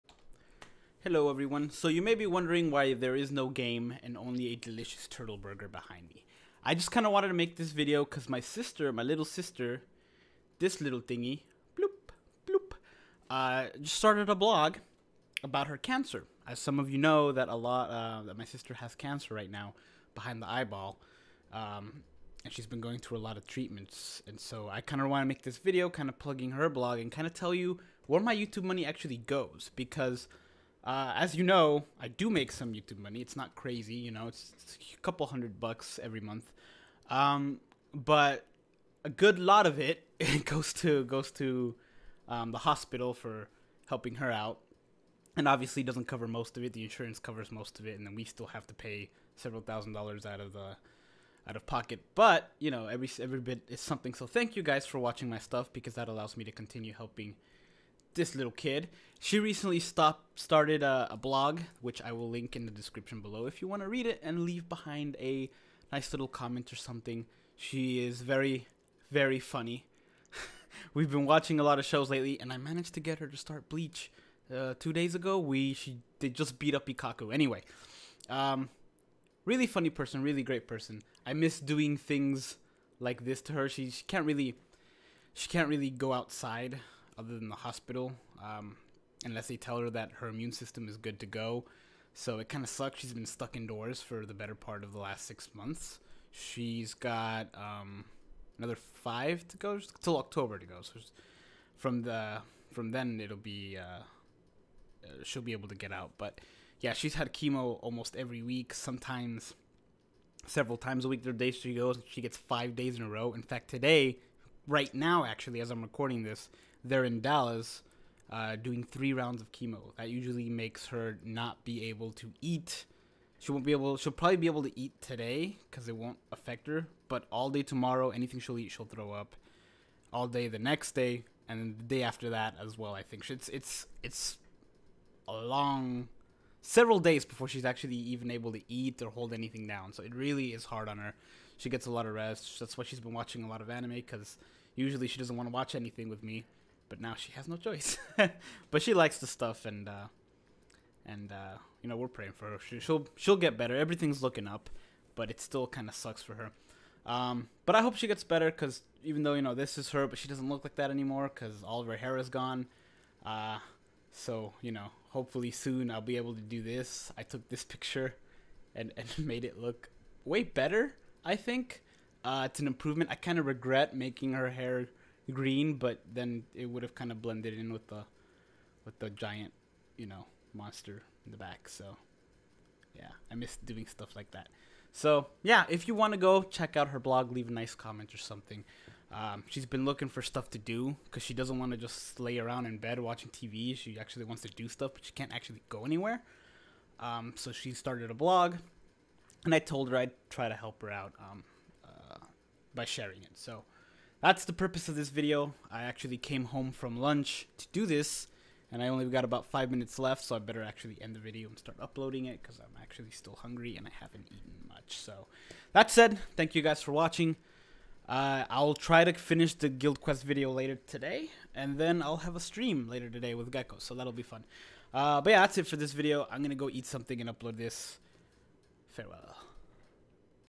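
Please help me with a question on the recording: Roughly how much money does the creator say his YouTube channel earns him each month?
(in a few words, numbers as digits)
a couple hundred bucks.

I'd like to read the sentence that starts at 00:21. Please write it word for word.
Um, and she's been going through a lot of treatments.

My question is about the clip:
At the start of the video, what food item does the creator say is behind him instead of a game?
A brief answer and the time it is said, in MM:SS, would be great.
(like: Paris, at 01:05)
turtle burger, at 00:05.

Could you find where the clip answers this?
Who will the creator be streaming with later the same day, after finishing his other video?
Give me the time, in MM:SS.
03:43.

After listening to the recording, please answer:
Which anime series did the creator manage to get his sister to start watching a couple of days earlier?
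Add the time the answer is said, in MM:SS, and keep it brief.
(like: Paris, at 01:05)
Bleach, at 01:13.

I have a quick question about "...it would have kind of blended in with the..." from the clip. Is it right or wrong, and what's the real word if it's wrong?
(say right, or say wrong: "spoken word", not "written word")
right.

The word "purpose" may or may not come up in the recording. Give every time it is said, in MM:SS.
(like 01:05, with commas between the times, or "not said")
03:24.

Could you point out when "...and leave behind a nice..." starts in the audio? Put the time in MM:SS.
01:04.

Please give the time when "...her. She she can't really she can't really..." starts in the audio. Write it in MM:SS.
01:23.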